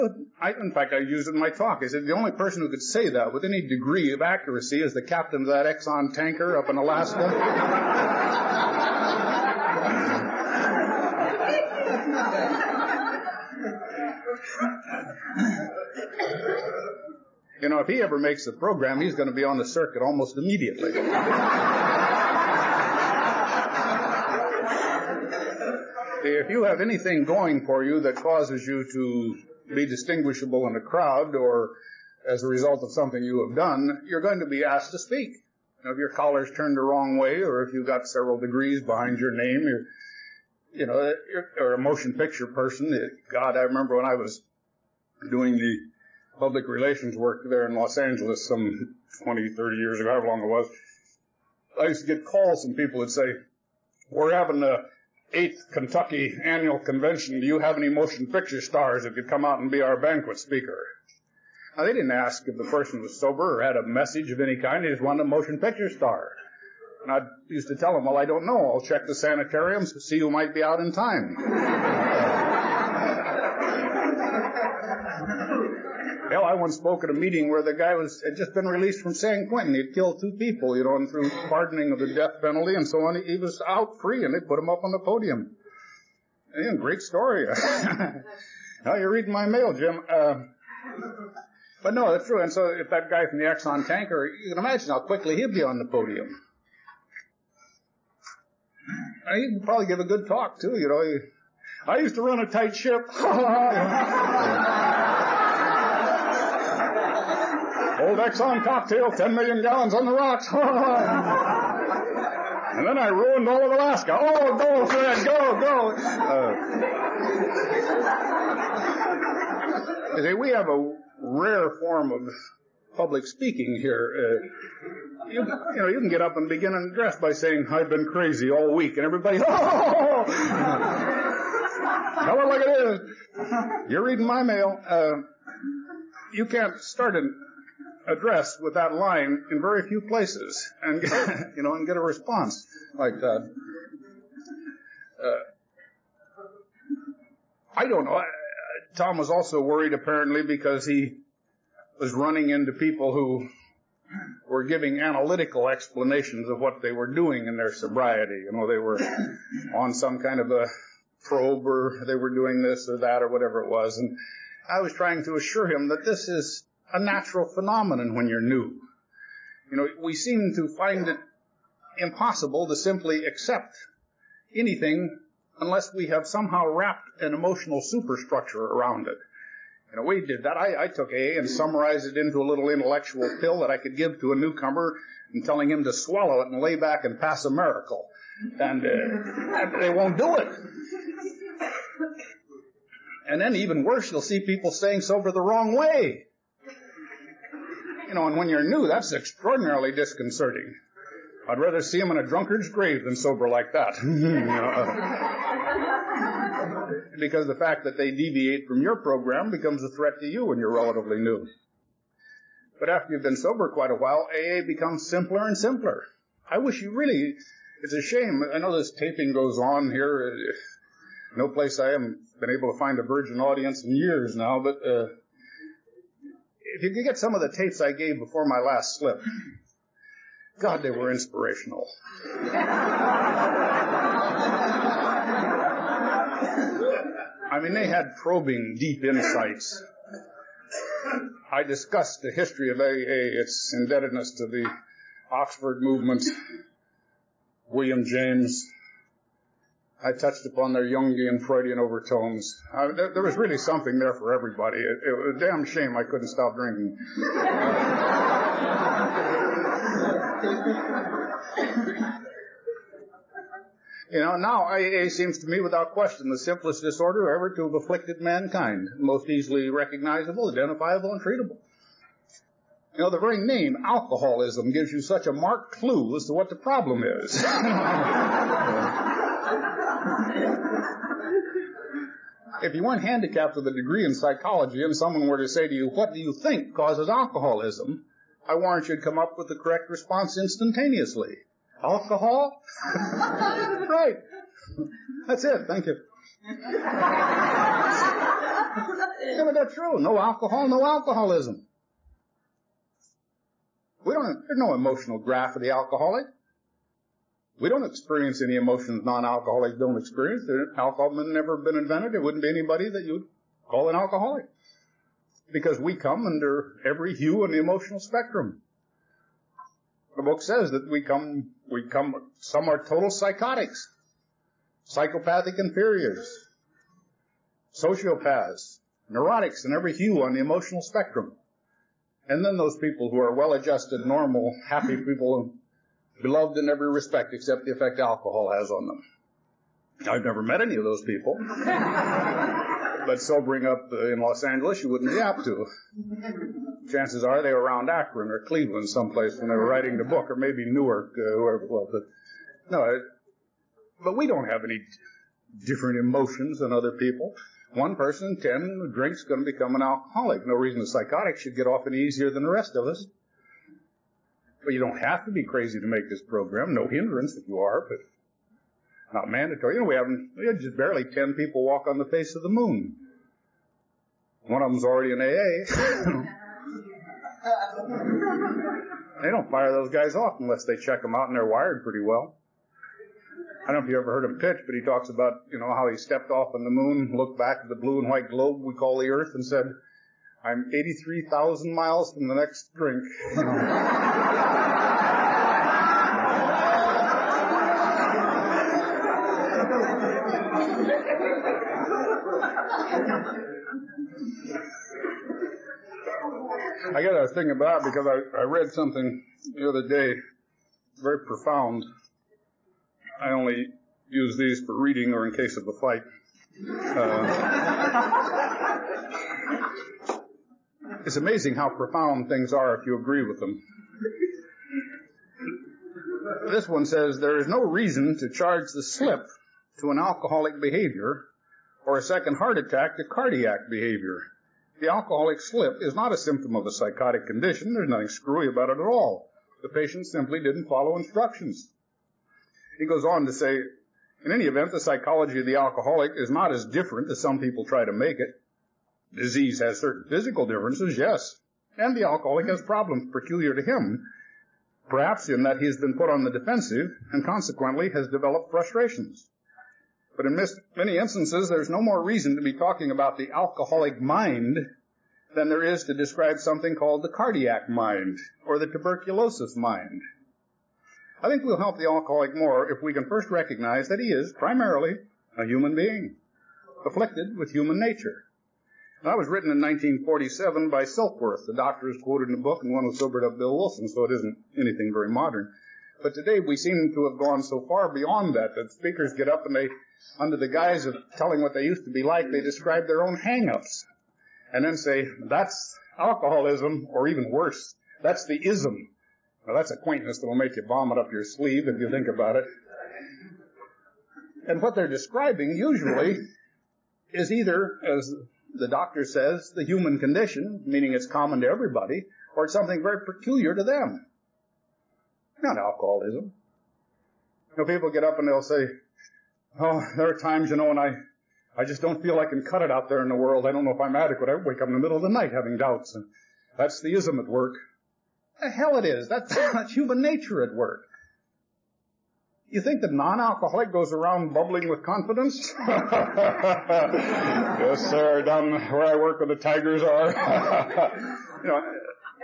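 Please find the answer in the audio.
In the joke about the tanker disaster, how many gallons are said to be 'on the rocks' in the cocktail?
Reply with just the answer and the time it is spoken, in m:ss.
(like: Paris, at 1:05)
10 million gallons, at 1:49.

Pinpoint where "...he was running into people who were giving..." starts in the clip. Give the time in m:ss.
2:30.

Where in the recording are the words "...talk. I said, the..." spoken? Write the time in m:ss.
0:01.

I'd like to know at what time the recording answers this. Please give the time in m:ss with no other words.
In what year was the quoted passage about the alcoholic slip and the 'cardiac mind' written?
7:59.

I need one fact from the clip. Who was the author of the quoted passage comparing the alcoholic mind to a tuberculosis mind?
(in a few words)
Silkworth.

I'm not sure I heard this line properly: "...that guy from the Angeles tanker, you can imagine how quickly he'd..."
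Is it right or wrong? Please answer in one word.
wrong.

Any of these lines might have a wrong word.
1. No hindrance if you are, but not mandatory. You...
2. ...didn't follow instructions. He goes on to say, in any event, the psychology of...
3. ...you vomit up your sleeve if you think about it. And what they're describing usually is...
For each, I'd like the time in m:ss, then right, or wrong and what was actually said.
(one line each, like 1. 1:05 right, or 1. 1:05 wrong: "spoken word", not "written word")
1. 6:06 right
2. 7:20 right
3. 8:20 right.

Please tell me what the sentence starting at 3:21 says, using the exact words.
I'd rather see him in a drunkard's grave than sober like that.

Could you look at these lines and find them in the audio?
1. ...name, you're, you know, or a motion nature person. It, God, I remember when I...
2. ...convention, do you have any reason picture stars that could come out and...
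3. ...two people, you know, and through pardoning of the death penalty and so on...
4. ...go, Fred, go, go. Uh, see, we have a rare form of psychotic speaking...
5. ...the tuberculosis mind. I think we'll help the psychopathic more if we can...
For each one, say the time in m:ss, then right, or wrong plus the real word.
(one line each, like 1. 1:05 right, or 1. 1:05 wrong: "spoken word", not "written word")
1. 0:39 wrong: "picture", not "nature"
2. 0:56 wrong: "motion", not "reason"
3. 1:20 right
4. 1:54 wrong: "public", not "psychotic"
5. 7:48 wrong: "alcoholic", not "psychopathic".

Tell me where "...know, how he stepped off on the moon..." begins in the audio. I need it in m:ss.
6:25.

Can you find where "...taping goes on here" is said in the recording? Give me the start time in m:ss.
3:38.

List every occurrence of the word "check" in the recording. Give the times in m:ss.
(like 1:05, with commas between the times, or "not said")
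1:08, 6:20.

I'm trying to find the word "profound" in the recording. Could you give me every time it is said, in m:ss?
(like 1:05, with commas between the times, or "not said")
6:51, 7:01.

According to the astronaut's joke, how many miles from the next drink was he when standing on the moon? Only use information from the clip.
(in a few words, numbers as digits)
83,000 miles.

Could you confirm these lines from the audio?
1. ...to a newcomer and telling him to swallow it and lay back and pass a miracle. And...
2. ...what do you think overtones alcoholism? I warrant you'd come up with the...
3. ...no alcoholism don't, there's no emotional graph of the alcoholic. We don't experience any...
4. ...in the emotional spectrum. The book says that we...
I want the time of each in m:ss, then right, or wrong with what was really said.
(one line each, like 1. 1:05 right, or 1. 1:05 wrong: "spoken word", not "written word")
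1. 3:04 right
2. 4:45 wrong: "causes", not "overtones"
3. 5:00 right
4. 5:17 right.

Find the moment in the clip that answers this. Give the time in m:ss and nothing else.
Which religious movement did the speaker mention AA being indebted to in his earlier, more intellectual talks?
4:05.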